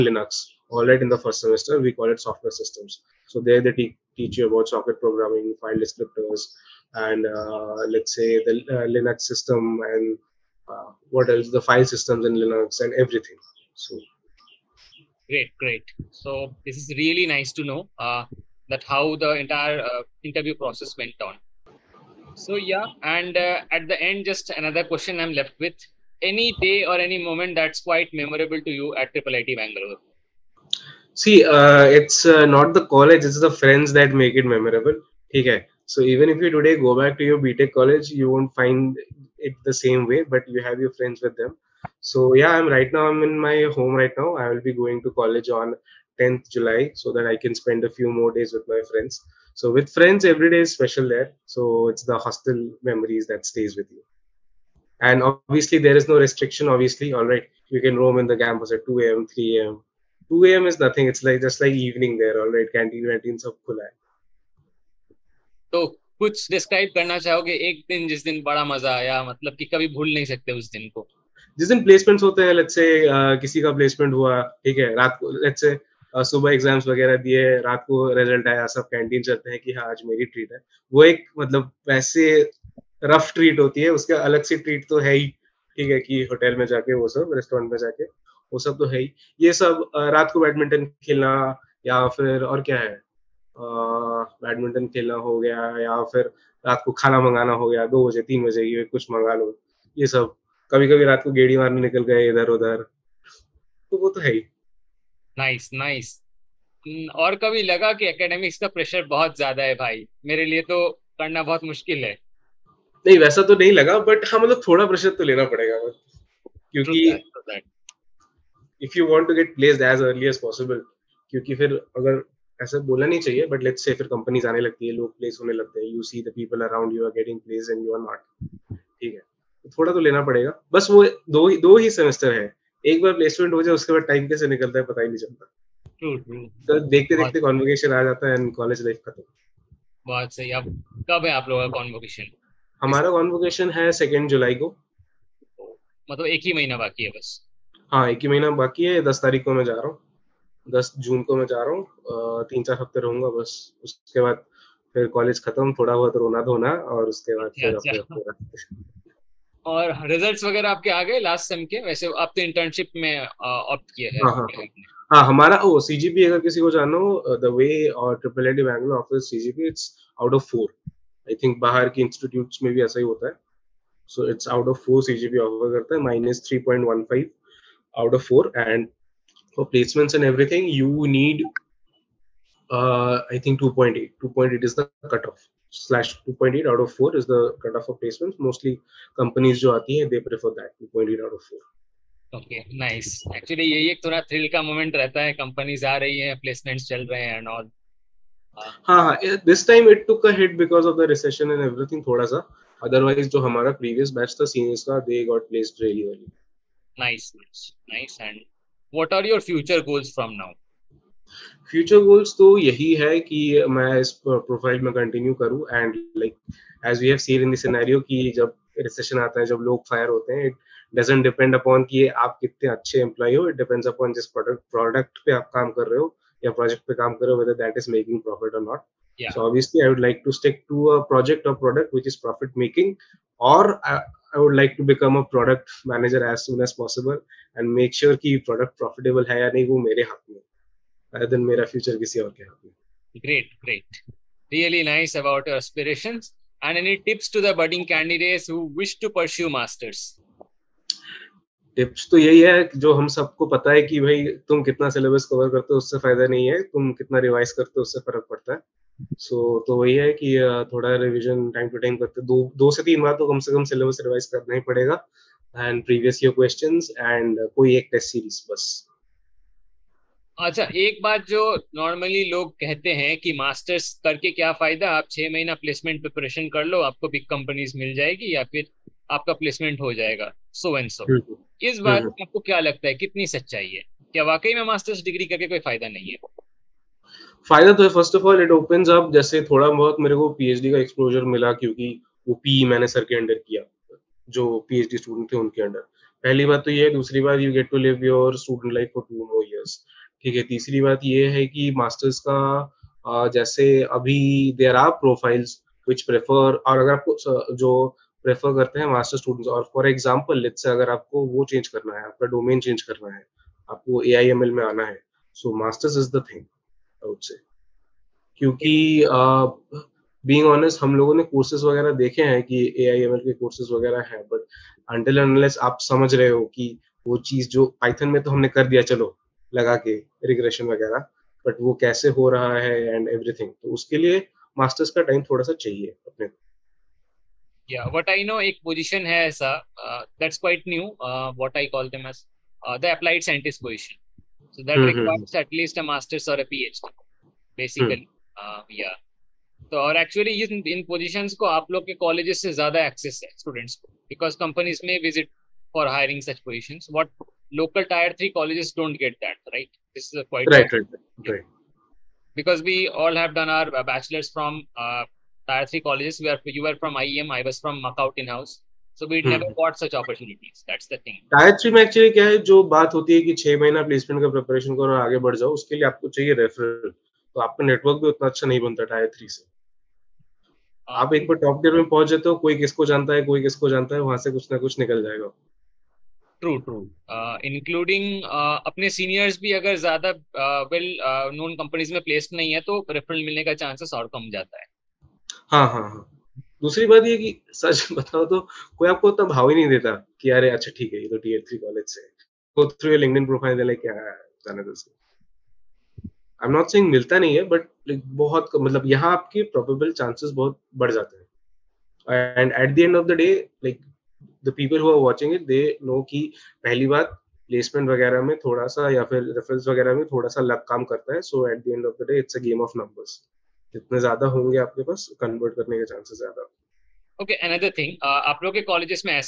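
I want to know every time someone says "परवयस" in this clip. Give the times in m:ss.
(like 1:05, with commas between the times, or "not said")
3:23, 4:25.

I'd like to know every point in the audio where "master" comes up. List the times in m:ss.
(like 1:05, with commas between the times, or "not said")
5:45.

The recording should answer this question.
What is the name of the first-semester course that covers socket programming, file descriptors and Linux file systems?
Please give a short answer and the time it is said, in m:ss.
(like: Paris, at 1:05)
Software Systems, at 0:02.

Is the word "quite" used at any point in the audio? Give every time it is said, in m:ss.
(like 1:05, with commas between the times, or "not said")
0:27, 6:00.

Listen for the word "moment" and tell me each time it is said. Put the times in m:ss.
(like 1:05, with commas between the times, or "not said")
0:27.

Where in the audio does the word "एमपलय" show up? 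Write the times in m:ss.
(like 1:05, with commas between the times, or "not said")
3:42.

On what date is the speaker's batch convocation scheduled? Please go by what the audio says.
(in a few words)
2nd July.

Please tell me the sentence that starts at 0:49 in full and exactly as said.
So with friends, every day is special there.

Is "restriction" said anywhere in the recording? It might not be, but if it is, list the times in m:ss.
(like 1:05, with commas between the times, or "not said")
0:56.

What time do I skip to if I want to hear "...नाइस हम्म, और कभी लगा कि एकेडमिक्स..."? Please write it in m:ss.
1:45.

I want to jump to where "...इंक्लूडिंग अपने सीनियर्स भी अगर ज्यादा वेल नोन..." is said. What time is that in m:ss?
6:27.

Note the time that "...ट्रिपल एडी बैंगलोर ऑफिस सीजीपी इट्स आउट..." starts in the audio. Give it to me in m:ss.
2:48.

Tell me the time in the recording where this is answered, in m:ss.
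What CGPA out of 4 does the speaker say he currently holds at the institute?
2:56.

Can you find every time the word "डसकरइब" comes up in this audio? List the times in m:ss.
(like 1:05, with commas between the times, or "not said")
1:06.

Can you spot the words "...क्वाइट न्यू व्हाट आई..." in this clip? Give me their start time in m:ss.
5:40.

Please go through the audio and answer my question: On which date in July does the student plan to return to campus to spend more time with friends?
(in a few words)
10th July.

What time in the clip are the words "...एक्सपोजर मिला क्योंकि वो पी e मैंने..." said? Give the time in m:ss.
4:50.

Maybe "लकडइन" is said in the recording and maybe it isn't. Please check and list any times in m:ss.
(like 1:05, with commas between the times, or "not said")
6:42.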